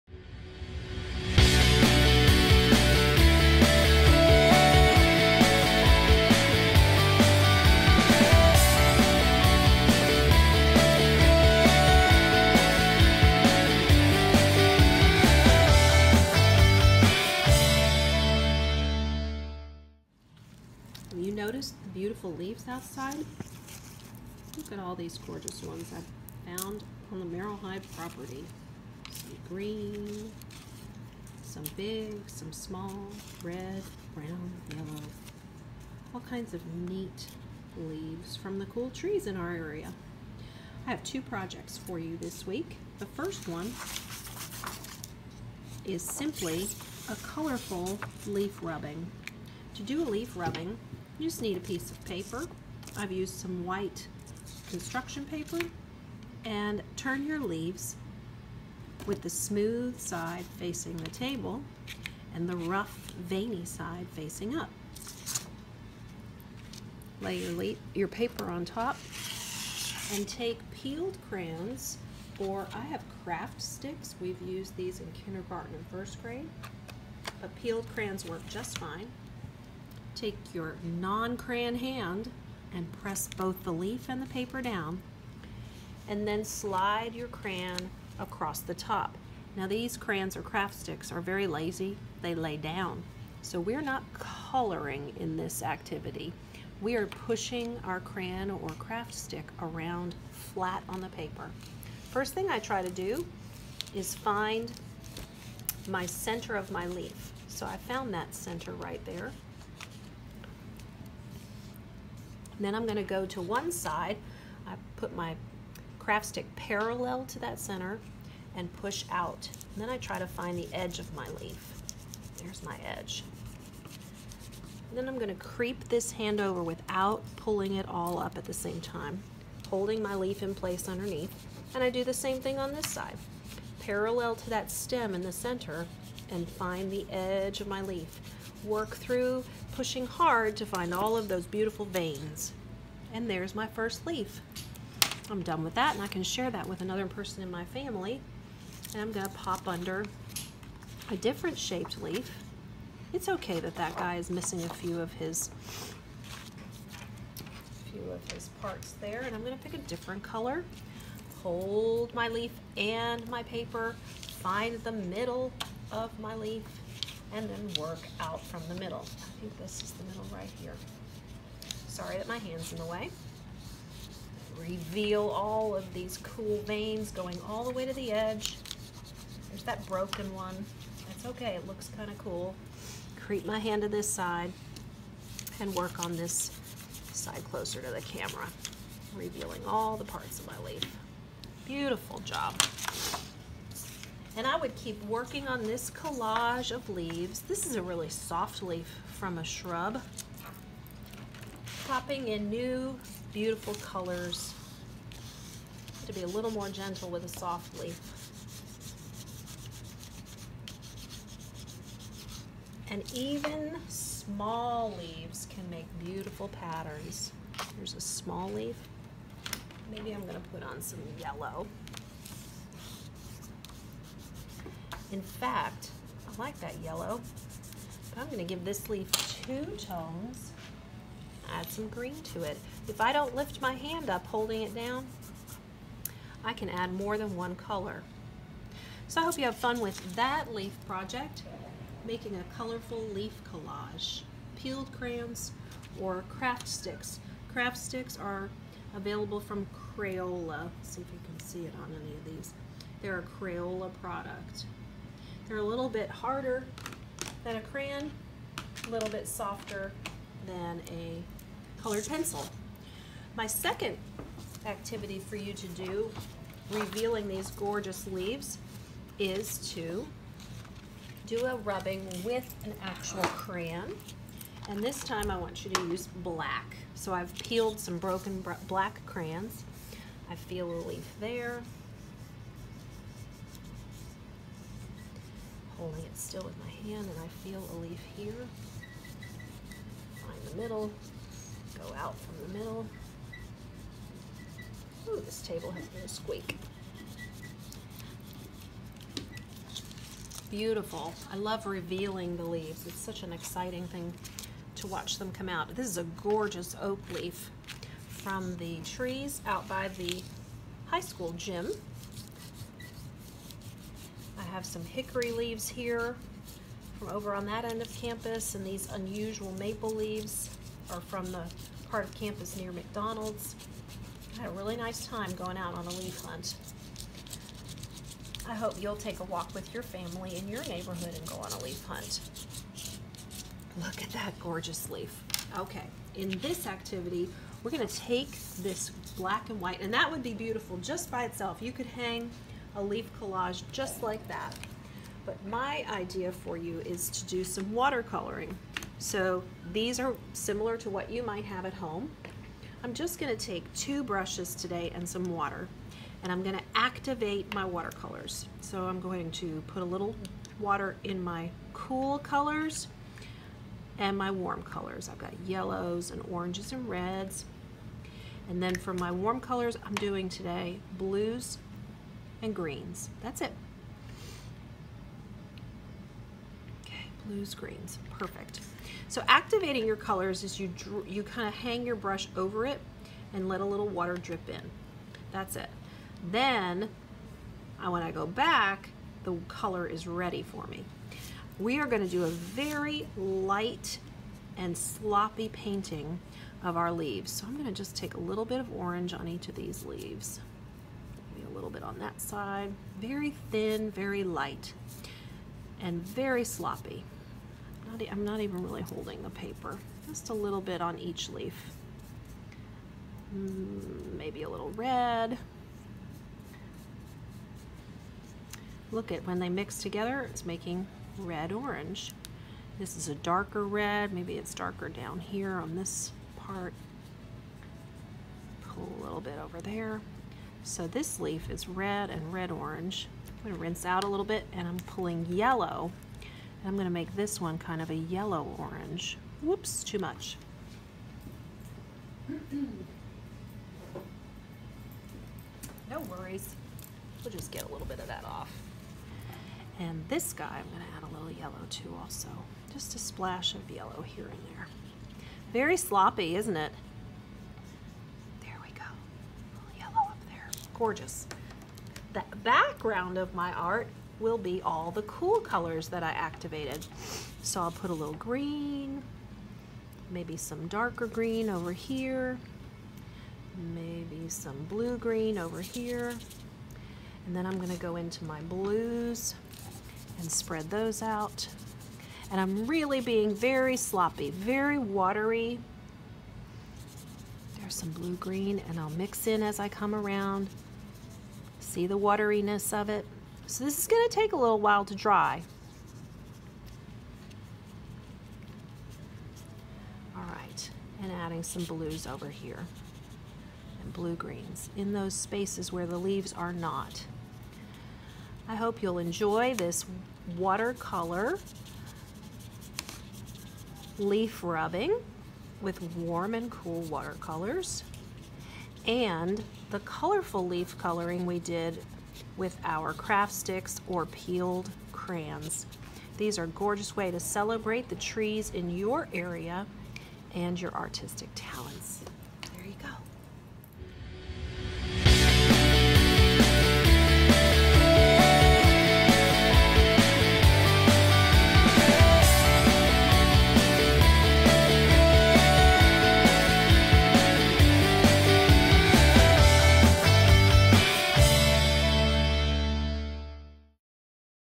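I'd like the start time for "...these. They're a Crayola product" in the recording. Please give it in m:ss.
4:12.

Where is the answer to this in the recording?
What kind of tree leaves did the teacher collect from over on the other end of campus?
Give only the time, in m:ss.
5:14.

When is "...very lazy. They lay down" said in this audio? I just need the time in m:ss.
1:31.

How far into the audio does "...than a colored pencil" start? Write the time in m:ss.
4:20.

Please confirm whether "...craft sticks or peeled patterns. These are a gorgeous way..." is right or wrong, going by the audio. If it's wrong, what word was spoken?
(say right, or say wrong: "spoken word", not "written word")
wrong: "crayons", not "patterns".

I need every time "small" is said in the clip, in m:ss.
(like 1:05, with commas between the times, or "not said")
0:32, 3:33, 3:38.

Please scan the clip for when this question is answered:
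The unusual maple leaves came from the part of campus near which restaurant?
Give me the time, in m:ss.
5:22.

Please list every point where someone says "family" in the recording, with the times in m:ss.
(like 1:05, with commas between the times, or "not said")
2:27, 5:29.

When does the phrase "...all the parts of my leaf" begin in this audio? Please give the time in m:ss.
3:09.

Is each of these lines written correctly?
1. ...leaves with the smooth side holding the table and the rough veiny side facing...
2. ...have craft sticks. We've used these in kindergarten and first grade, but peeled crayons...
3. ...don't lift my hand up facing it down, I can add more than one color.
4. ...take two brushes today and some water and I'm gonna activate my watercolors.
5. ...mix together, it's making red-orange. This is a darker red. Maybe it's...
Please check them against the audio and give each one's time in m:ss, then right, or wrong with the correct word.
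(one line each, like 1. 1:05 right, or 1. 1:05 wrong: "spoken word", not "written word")
1. 0:57 wrong: "facing", not "holding"
2. 1:12 right
3. 3:53 wrong: "holding", not "facing"
4. 5:53 right
5. 6:59 right.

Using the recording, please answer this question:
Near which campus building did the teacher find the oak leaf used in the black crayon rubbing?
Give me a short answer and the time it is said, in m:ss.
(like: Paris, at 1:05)
High school gym, at 5:10.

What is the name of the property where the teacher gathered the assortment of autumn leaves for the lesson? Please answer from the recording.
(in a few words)
Merrill Hive.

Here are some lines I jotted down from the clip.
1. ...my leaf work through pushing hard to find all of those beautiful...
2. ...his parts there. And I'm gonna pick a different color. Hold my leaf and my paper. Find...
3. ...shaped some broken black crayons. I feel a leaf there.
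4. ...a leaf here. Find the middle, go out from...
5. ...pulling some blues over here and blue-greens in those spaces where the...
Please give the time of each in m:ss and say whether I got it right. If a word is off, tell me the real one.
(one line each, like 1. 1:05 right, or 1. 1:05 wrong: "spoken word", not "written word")
1. 2:17 right
2. 2:38 right
3. 4:37 wrong: "peeled", not "shaped"
4. 4:47 right
5. 8:21 wrong: "adding", not "pulling".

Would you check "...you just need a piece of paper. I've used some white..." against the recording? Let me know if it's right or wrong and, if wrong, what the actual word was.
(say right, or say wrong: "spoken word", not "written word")
right.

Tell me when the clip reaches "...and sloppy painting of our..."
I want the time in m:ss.
6:34.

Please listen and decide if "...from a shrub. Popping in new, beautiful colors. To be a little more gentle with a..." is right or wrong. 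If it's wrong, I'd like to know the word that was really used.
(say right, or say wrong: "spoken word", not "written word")
right.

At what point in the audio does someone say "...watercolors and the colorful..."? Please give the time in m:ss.
8:36.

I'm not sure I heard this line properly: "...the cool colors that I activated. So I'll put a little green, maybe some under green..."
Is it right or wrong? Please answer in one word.
wrong.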